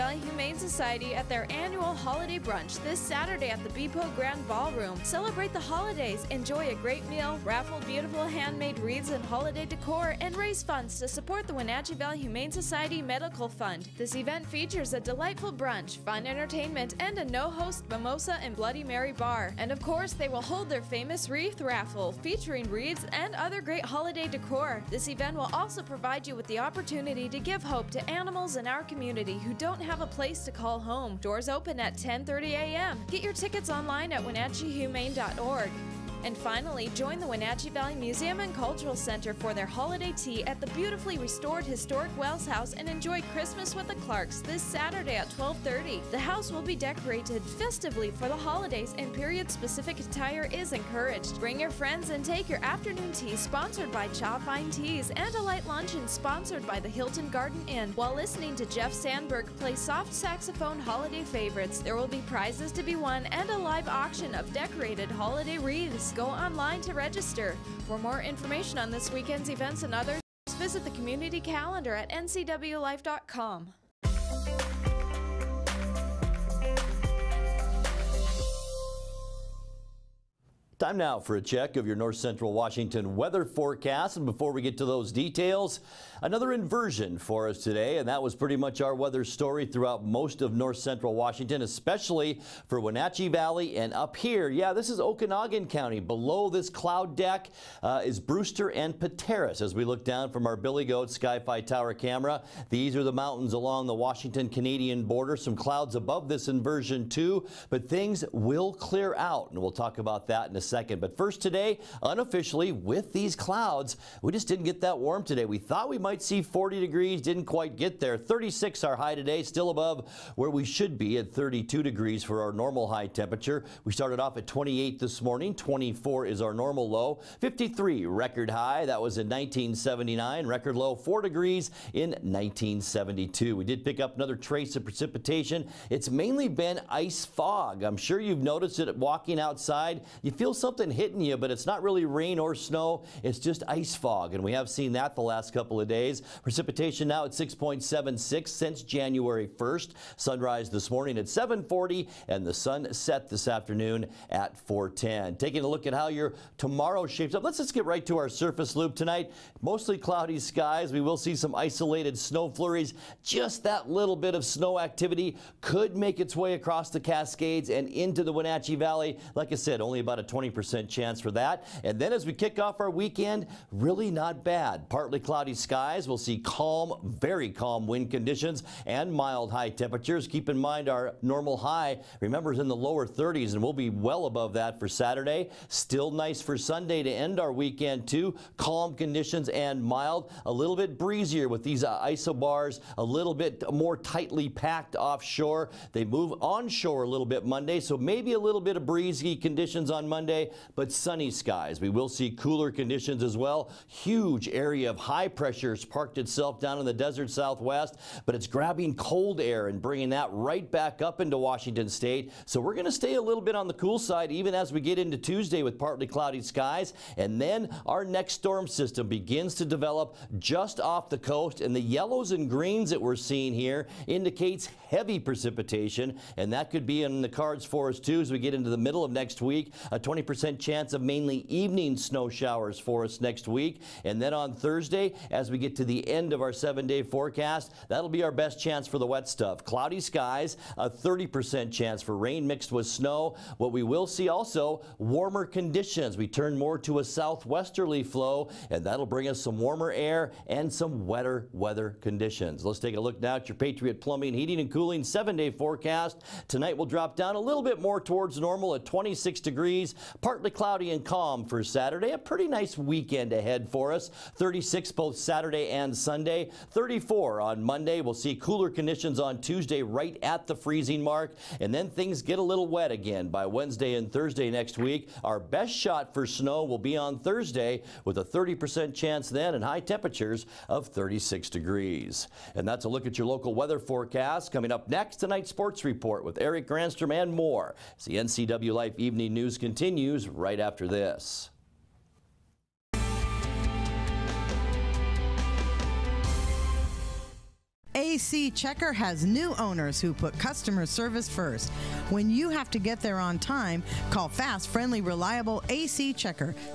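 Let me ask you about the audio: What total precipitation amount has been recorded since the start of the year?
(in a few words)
6.76.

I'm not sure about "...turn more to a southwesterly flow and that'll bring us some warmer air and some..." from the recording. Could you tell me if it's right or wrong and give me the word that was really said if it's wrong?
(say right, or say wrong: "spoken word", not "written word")
right.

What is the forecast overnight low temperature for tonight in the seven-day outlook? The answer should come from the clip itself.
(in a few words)
26 degrees.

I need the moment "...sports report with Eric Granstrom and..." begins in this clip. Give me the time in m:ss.
4:45.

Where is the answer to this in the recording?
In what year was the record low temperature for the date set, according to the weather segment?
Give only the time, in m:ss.
2:12.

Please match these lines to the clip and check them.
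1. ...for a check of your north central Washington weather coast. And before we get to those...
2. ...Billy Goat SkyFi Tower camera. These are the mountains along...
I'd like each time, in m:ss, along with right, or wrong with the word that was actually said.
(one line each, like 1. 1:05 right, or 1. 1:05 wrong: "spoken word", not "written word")
1. 1:21 wrong: "forecast", not "coast"
2. 1:40 right.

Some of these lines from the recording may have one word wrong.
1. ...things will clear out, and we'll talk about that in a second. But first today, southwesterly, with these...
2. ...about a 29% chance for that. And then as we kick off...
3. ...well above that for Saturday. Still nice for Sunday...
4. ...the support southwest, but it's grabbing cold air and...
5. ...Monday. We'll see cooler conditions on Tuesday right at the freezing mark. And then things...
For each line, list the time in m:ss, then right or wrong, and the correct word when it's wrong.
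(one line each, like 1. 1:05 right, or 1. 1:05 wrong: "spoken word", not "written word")
1. 1:47 wrong: "unofficially", not "southwesterly"
2. 2:49 wrong: "20", not "29"
3. 3:03 right
4. 3:26 wrong: "desert", not "support"
5. 4:27 right.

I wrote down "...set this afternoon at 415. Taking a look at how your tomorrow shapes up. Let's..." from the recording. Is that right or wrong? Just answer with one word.
wrong.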